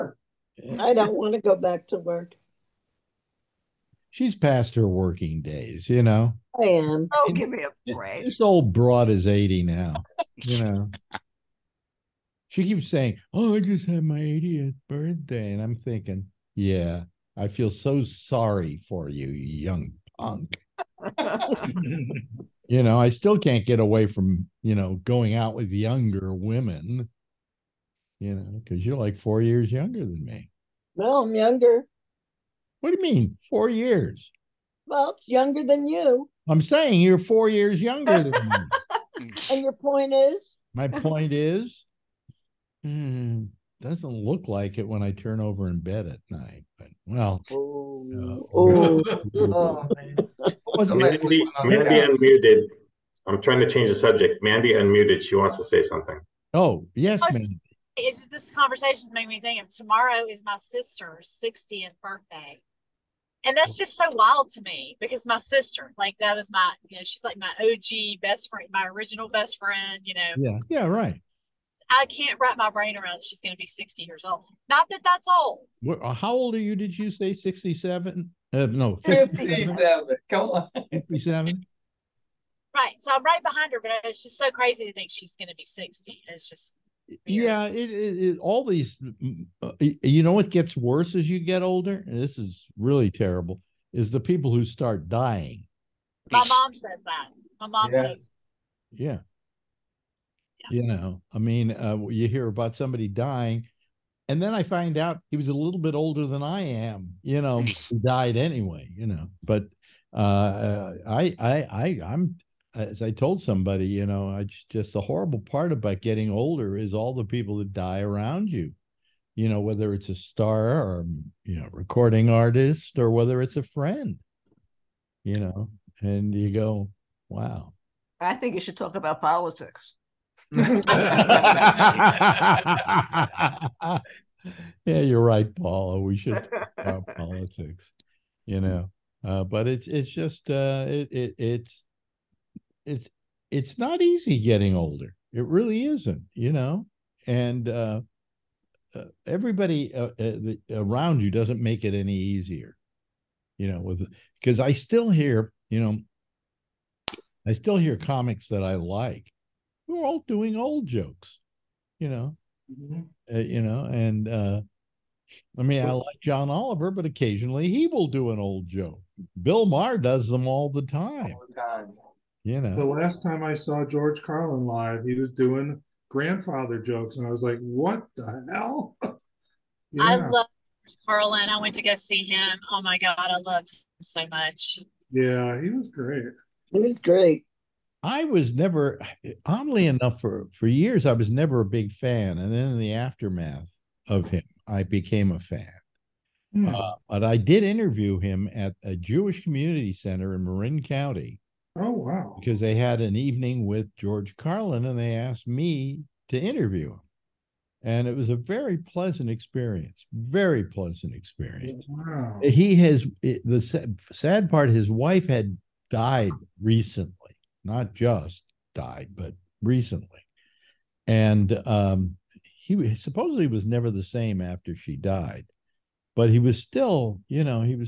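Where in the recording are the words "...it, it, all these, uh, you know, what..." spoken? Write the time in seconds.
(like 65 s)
87 s.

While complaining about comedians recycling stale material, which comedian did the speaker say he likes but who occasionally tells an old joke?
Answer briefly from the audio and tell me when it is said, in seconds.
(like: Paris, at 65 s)
John Oliver, at 166 s.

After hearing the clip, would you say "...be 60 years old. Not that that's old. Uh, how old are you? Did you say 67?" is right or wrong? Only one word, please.
right.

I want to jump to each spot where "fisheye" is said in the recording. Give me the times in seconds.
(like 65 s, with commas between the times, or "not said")
not said.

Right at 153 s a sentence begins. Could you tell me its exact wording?
With because I still hear, you know, I still hear comics that I like.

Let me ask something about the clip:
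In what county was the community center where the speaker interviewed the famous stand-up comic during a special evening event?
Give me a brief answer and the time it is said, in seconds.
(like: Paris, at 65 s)
Marin County, at 200 s.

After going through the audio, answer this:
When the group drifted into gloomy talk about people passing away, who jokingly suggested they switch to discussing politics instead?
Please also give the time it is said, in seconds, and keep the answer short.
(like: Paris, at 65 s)
Paula, at 135 s.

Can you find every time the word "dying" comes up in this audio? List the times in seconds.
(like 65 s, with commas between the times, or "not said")
95 s, 103 s.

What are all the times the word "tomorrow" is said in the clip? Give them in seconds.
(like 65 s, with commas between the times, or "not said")
59 s.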